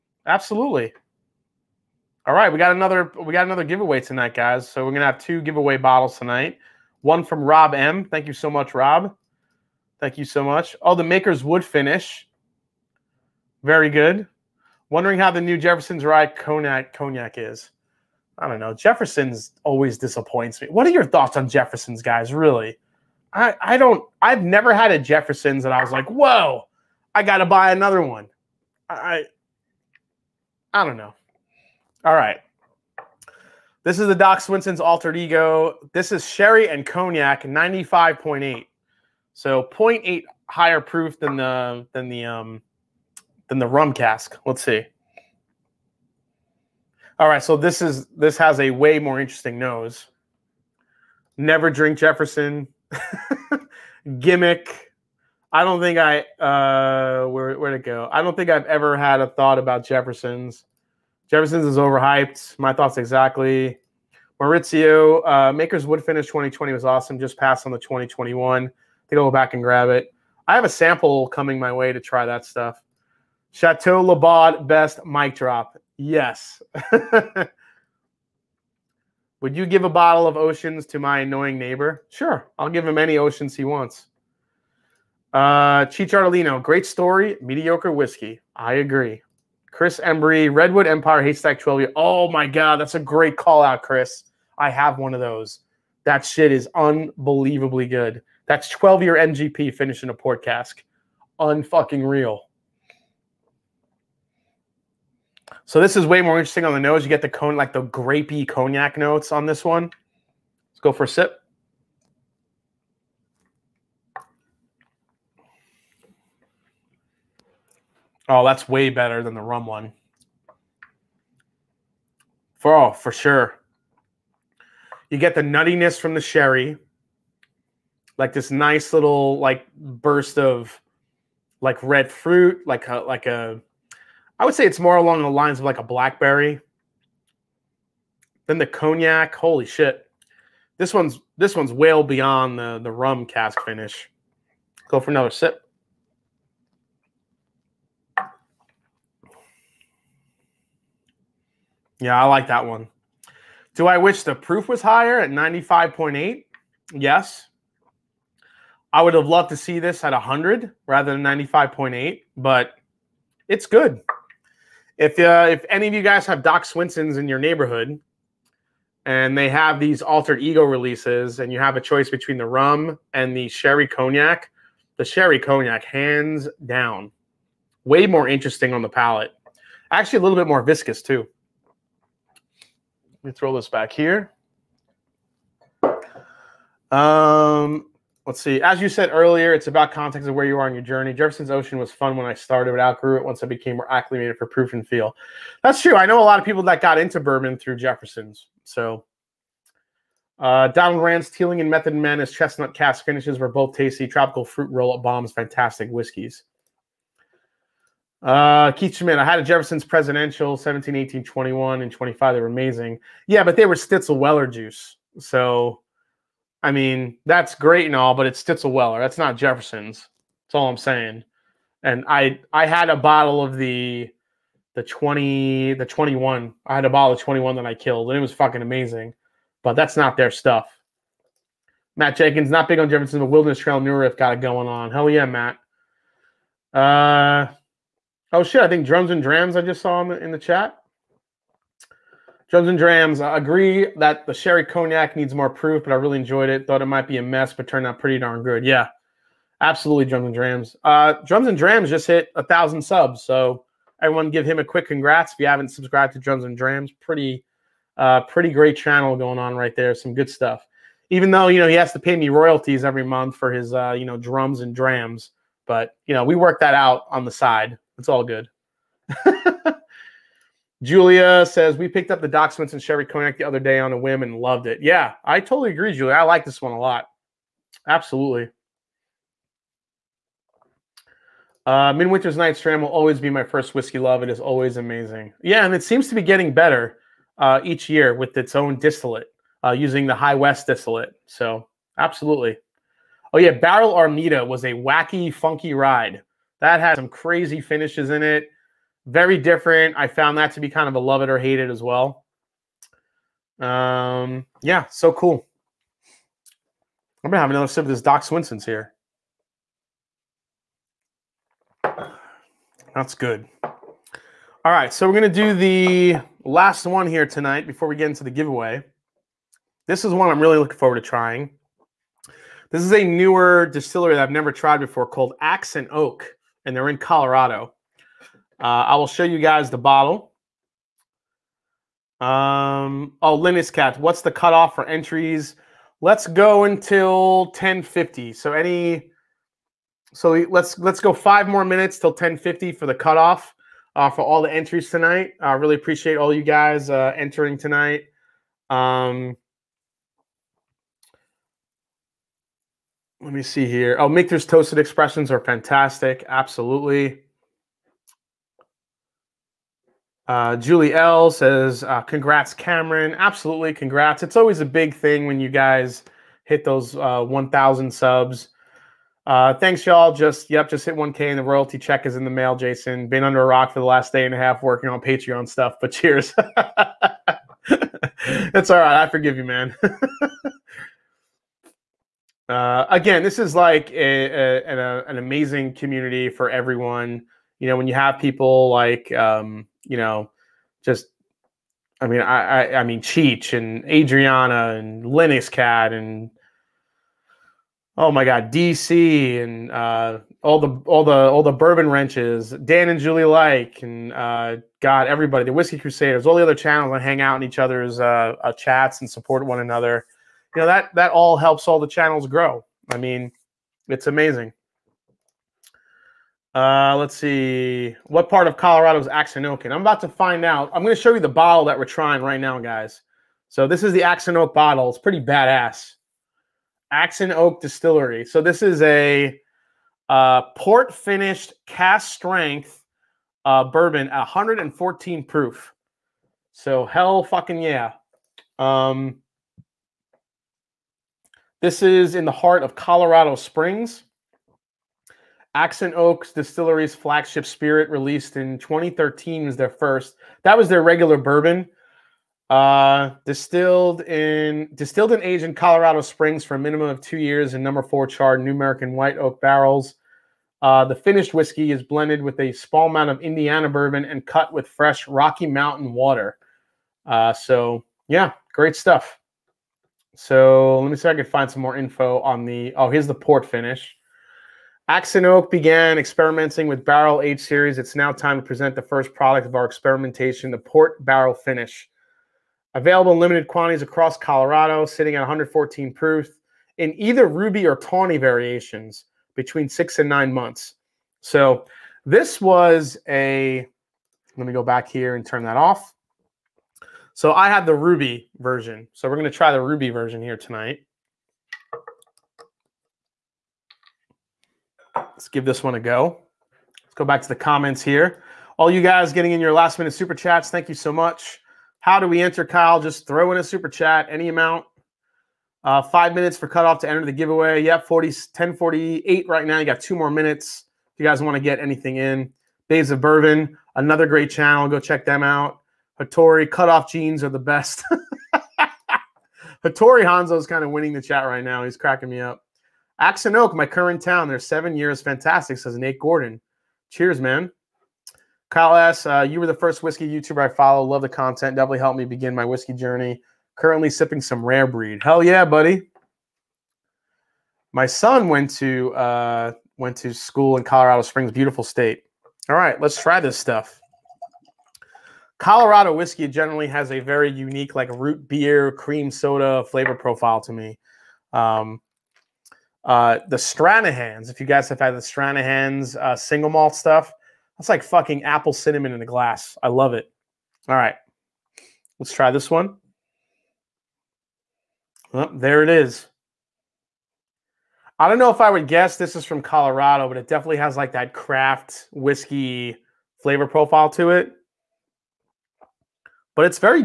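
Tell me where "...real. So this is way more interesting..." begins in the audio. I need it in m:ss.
1:42.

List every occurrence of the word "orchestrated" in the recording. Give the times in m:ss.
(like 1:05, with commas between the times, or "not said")
not said.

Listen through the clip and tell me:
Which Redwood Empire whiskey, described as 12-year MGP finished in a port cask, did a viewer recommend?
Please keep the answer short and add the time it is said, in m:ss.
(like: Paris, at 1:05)
Haystack, at 1:31.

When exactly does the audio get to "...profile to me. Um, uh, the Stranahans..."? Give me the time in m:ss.
9:19.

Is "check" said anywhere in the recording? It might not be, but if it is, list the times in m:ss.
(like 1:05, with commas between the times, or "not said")
6:11, 8:44.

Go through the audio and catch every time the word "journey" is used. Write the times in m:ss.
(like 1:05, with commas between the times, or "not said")
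3:10, 9:02.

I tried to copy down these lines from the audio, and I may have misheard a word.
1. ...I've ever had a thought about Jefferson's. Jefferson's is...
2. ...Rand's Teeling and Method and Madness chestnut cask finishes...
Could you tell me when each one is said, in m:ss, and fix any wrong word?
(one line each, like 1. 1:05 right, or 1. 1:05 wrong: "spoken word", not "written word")
1. 0:58 right
2. 3:21 right.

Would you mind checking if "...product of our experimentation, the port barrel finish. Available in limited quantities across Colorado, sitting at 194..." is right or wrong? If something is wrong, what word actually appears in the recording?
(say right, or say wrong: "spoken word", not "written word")
wrong: "114", not "194".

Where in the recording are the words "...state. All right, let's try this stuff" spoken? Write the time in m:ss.
9:11.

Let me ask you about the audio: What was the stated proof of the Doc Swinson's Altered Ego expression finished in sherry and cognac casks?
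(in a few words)
95.8.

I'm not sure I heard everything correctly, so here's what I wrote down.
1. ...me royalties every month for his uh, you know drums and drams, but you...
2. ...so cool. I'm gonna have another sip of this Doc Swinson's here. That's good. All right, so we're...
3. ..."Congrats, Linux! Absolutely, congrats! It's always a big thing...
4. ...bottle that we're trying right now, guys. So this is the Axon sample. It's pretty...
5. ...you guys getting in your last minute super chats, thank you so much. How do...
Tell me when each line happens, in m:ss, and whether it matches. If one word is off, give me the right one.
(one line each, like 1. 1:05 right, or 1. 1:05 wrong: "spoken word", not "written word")
1. 4:22 right
2. 5:04 right
3. 6:02 wrong: "Cameron", not "Linux"
4. 7:01 wrong: "bottle", not "sample"
5. 8:28 right.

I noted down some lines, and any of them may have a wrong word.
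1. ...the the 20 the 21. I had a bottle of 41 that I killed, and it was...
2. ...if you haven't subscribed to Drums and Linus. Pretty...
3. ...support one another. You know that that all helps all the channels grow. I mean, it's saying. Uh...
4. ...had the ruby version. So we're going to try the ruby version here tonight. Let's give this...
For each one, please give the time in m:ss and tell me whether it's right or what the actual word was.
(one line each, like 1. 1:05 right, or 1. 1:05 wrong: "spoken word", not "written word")
1. 3:43 wrong: "21", not "41"
2. 4:15 wrong: "Drams", not "Linus"
3. 6:49 wrong: "amazing", not "saying"
4. 8:17 right.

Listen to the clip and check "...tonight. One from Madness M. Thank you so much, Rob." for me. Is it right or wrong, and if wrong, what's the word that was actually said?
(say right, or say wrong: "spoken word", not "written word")
wrong: "Rob", not "Madness".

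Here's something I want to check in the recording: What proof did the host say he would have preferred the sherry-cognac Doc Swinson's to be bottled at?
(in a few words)
100.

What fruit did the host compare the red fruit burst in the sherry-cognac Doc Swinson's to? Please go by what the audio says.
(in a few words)
Blackberry.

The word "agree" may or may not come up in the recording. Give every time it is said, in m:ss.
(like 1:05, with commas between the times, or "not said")
1:28, 4:03, 4:35.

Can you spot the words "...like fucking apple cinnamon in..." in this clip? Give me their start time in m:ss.
9:27.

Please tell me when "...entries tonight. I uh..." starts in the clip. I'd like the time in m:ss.
5:44.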